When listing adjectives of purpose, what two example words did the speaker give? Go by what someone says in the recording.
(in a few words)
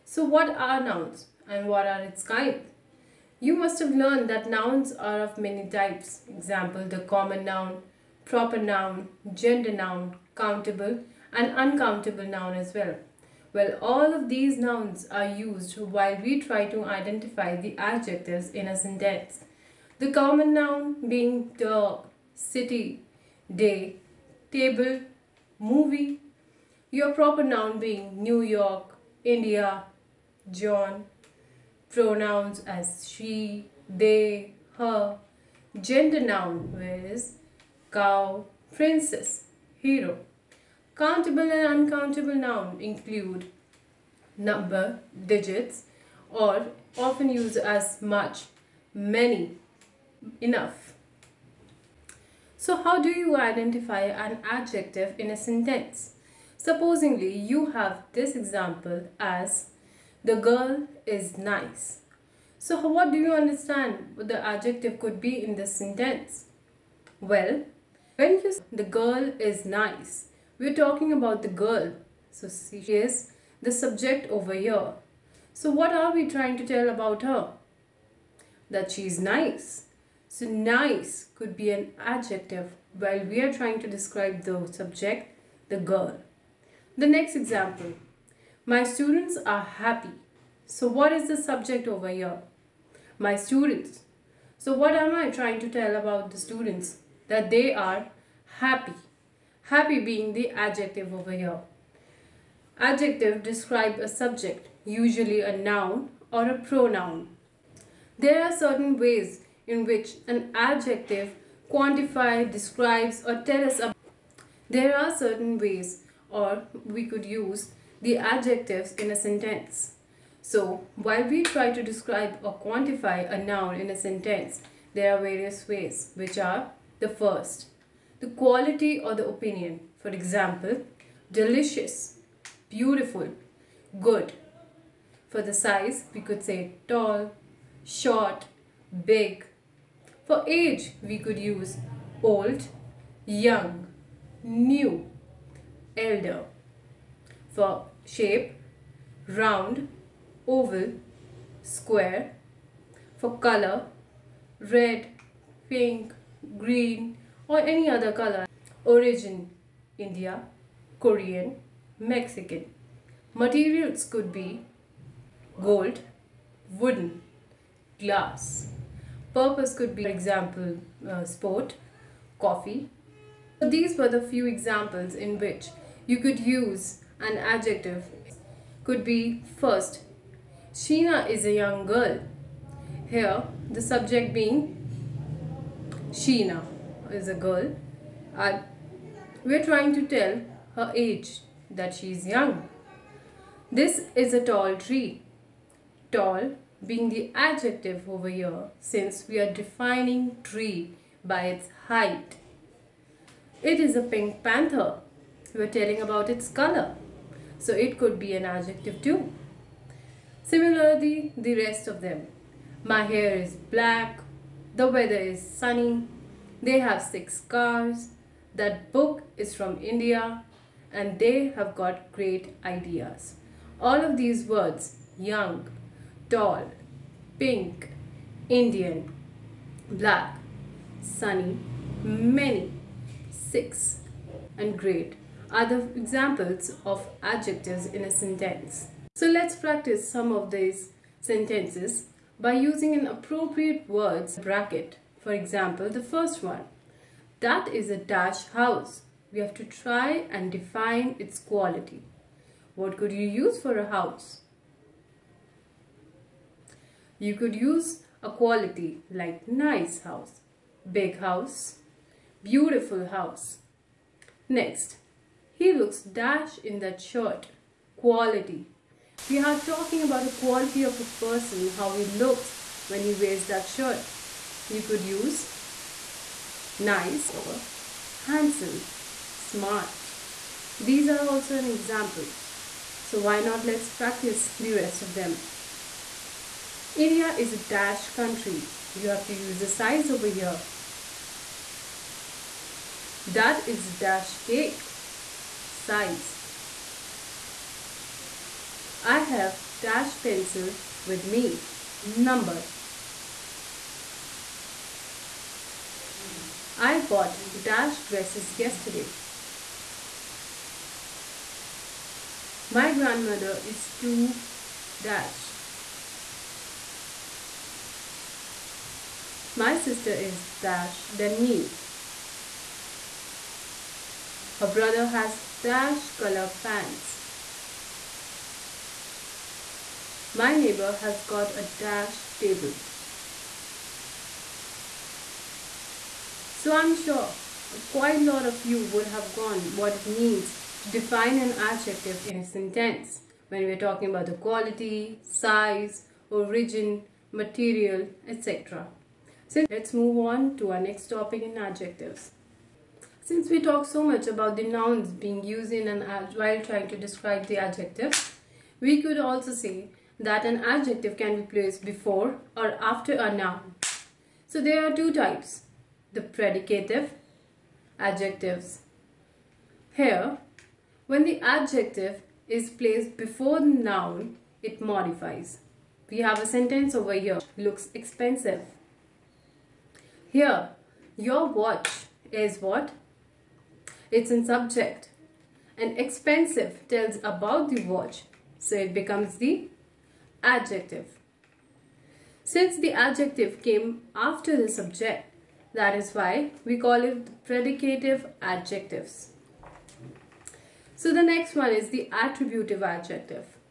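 sport, coffee.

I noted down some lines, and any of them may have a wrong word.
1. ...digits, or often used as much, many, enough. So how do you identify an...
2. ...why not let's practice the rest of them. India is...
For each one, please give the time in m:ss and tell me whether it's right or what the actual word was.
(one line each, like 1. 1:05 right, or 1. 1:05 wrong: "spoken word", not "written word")
1. 0:45 right
2. 4:43 right.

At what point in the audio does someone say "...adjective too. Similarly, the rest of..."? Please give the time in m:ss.
3:28.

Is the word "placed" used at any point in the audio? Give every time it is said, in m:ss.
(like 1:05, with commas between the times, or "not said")
6:01, 6:12.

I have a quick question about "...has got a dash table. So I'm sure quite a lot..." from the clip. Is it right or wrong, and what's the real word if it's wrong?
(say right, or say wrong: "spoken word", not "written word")
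right.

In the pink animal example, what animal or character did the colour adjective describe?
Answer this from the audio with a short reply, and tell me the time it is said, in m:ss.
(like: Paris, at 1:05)
panther, at 3:24.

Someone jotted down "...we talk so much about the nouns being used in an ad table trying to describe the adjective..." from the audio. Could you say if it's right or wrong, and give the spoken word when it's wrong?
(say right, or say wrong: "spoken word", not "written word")
wrong: "while", not "table".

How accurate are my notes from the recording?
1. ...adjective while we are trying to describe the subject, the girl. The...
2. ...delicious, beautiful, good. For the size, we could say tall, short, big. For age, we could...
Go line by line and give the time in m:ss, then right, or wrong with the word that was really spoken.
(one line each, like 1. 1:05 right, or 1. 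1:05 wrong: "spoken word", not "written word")
1. 1:22 right
2. 2:11 right.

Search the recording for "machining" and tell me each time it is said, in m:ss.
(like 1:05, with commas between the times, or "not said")
not said.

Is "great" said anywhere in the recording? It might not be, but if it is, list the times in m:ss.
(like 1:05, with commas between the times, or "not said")
3:42, 3:54.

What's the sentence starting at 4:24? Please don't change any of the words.
Next, he looks dash in that shirt.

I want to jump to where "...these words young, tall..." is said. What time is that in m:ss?
3:44.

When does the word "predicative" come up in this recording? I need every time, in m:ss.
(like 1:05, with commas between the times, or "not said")
6:06, 6:37.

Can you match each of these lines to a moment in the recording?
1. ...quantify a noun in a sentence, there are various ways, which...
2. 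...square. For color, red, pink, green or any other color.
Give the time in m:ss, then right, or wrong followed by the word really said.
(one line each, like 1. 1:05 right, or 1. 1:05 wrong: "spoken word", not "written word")
1. 2:02 right
2. 2:31 right.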